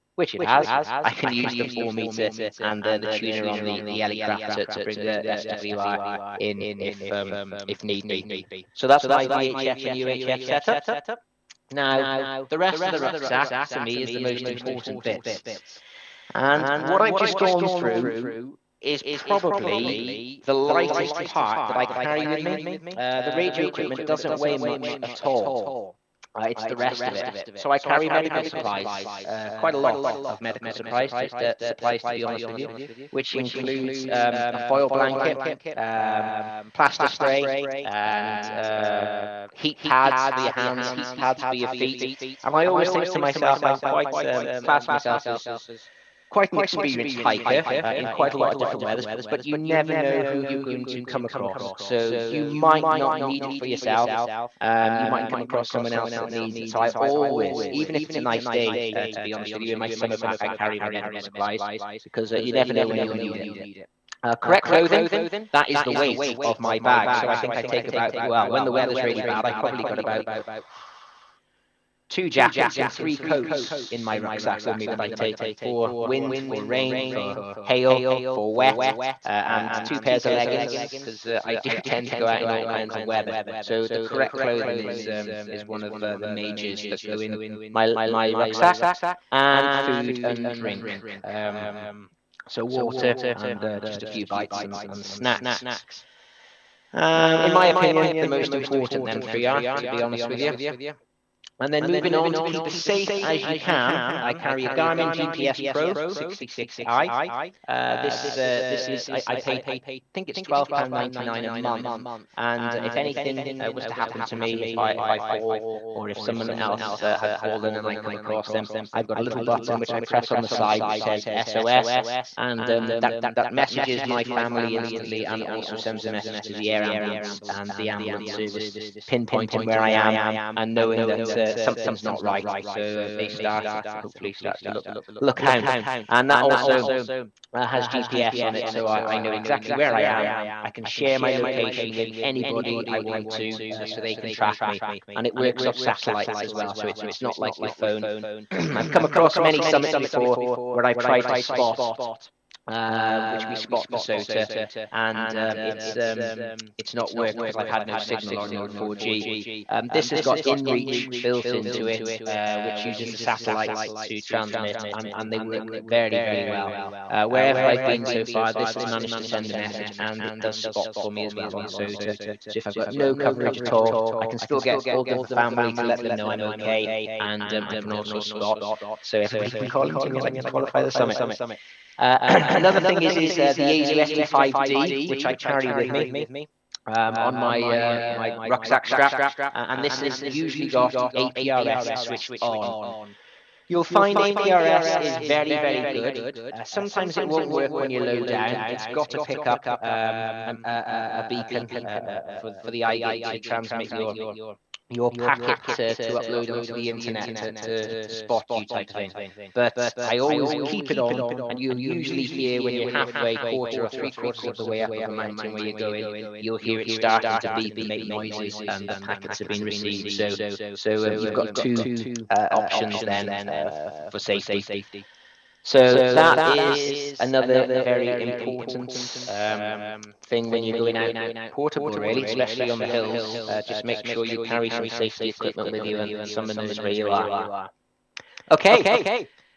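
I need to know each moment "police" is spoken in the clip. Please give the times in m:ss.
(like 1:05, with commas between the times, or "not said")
not said.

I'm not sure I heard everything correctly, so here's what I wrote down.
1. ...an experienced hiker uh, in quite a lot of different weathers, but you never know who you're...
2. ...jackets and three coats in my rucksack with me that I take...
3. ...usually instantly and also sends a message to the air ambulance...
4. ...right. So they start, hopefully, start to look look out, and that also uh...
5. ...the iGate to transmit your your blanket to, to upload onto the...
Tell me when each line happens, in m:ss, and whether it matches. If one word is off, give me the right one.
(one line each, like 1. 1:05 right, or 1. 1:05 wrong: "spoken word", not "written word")
1. 0:46 right
2. 1:12 right
3. 2:04 wrong: "family", not "usually"
4. 2:12 right
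5. 3:22 wrong: "packet", not "blanket".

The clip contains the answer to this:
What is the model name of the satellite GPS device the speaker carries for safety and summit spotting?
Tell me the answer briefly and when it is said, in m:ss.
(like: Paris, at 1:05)
Garmin GPS Pro 66i, at 1:44.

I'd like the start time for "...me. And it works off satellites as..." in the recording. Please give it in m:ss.
2:24.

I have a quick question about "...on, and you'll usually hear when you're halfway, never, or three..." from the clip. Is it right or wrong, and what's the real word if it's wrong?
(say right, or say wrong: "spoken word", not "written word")
wrong: "quarter", not "never".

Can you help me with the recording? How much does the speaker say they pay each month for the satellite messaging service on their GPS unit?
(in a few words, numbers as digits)
£12.99.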